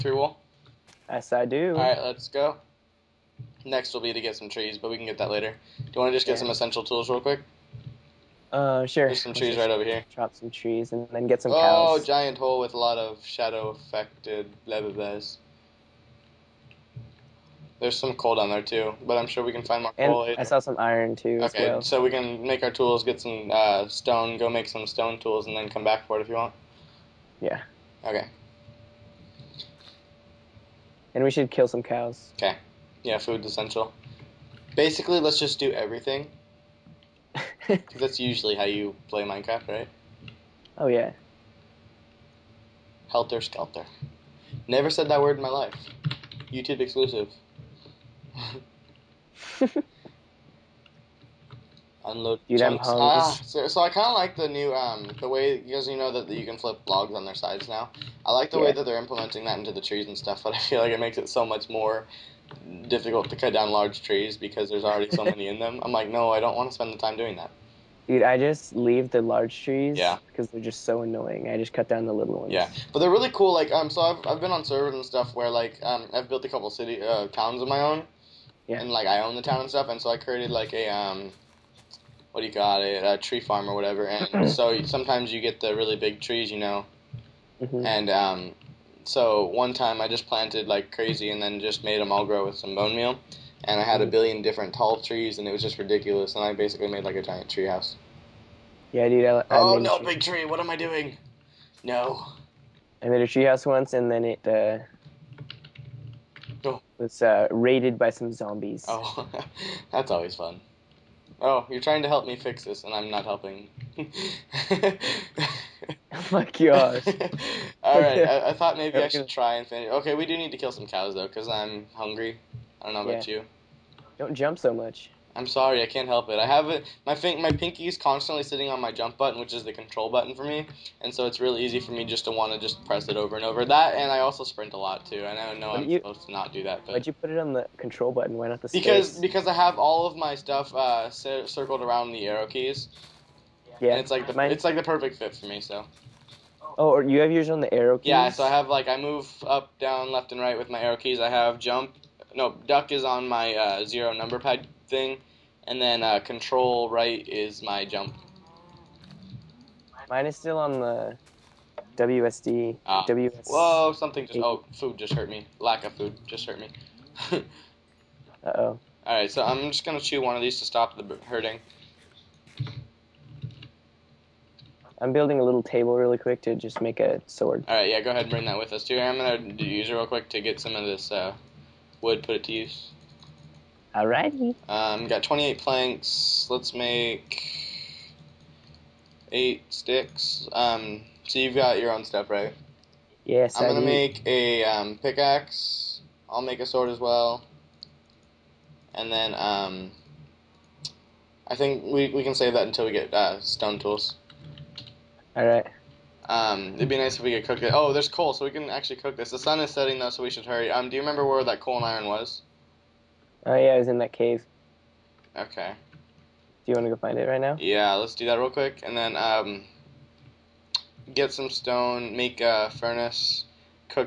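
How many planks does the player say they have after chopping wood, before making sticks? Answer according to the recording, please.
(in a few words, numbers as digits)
28.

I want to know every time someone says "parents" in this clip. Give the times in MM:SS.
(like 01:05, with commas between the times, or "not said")
not said.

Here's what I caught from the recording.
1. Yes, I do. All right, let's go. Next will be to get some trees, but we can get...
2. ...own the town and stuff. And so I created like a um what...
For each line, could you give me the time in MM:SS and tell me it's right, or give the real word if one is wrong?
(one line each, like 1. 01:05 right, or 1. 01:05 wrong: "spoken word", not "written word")
1. 00:01 right
2. 01:19 right.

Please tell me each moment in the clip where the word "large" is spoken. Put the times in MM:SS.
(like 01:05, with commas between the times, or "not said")
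01:03, 01:09.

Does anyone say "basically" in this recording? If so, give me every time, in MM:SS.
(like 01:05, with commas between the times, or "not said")
00:34, 01:36.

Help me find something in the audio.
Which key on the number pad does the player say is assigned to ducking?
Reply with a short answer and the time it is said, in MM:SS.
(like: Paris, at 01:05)
Zero, at 02:33.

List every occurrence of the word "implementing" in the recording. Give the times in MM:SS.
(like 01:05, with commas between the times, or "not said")
00:58.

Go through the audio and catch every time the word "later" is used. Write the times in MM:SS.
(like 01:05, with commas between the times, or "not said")
00:05, 00:20.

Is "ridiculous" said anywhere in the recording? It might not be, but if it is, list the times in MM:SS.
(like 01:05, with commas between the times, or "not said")
01:35.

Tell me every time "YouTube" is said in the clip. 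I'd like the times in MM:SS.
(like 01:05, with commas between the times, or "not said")
00:46.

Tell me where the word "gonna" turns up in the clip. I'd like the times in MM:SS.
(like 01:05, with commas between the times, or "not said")
02:49, 02:59, 03:13.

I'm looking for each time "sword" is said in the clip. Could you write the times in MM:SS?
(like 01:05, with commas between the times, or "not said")
02:57, 03:16.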